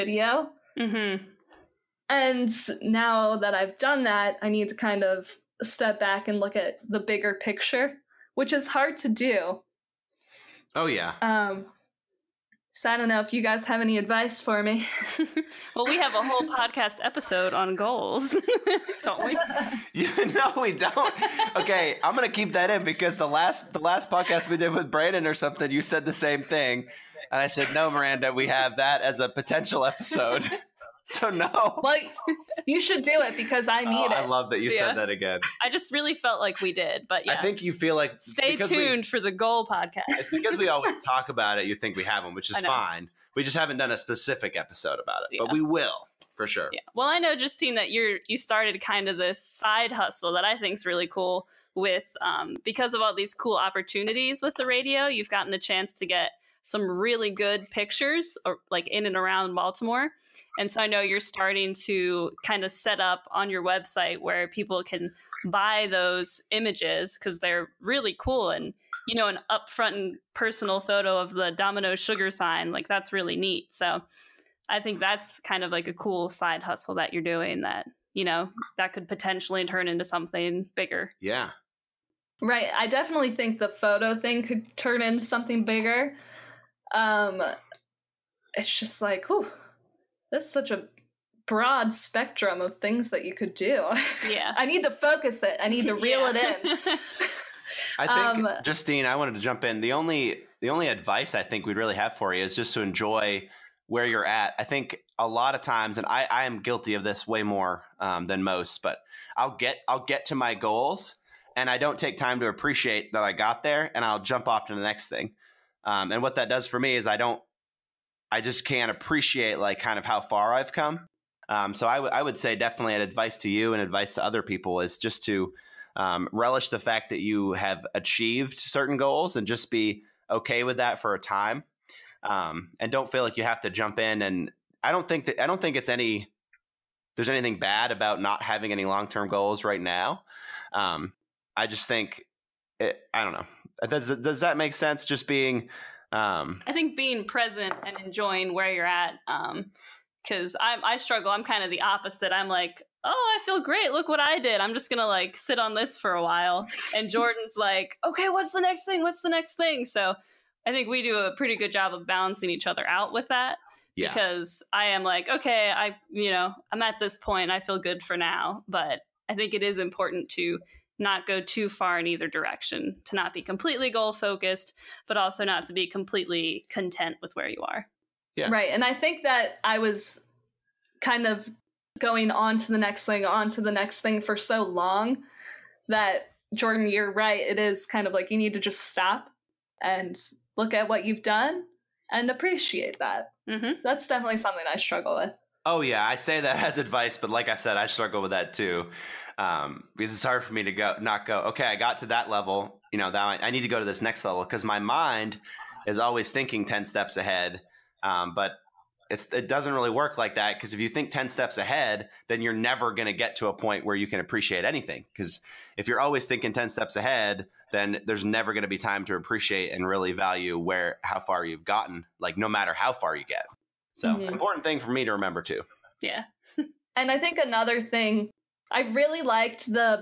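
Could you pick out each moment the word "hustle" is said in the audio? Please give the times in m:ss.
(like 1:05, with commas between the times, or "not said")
0:49, 1:16.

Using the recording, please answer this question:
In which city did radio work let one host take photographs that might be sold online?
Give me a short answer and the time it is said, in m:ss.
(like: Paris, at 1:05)
Baltimore, at 0:59.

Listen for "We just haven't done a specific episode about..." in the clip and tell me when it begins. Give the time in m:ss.
0:43.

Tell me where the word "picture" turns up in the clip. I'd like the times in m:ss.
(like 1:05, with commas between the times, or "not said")
0:07, 0:57.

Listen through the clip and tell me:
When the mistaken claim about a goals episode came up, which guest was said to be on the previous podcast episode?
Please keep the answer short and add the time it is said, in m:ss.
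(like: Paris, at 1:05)
Brandon, at 0:24.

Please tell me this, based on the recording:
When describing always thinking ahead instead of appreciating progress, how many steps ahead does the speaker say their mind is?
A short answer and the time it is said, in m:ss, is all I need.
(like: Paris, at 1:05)
10, at 3:26.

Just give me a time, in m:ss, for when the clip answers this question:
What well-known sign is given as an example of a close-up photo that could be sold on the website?
1:11.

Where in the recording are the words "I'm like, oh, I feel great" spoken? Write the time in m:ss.
2:32.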